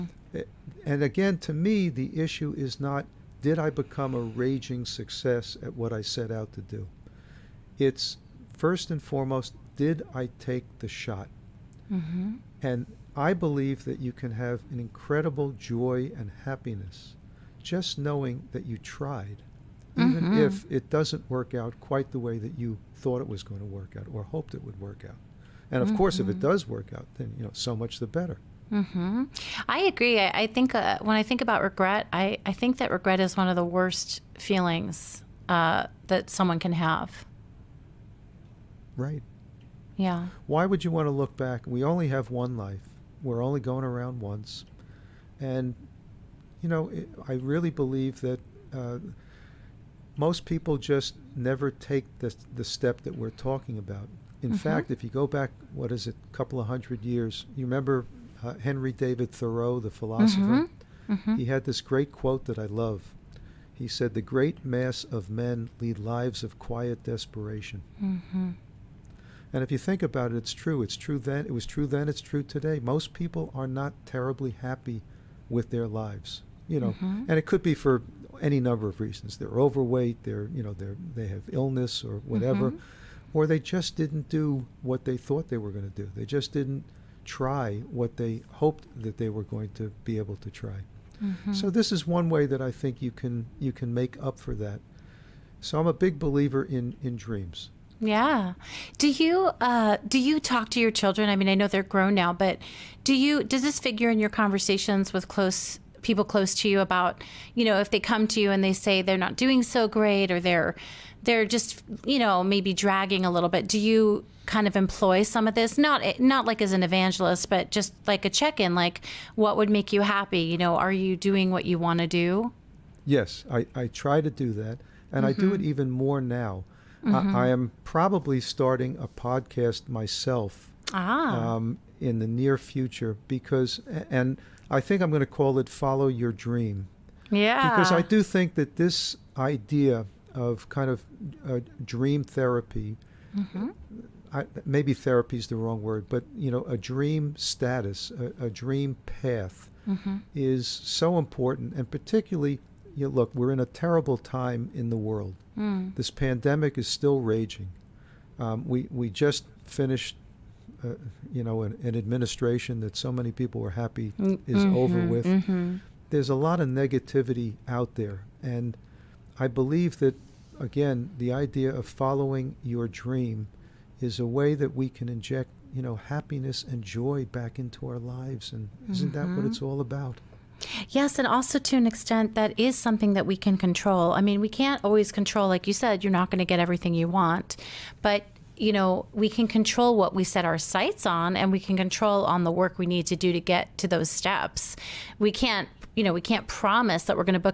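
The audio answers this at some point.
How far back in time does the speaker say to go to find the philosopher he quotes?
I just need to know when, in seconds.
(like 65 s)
56 s.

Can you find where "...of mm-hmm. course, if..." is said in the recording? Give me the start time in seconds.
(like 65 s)
25 s.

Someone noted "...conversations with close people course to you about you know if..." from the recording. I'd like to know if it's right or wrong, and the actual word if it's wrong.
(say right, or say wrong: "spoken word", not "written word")
wrong: "close", not "course".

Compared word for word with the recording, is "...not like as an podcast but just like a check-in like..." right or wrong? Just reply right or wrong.
wrong.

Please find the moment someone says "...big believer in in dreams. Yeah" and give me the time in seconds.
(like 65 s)
95 s.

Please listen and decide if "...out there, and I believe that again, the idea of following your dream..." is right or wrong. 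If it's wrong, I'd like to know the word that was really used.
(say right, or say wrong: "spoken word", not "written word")
right.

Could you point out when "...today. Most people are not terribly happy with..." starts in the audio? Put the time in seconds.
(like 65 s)
72 s.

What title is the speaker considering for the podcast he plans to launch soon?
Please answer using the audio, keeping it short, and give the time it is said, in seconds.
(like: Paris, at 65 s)
Follow Your Dream, at 135 s.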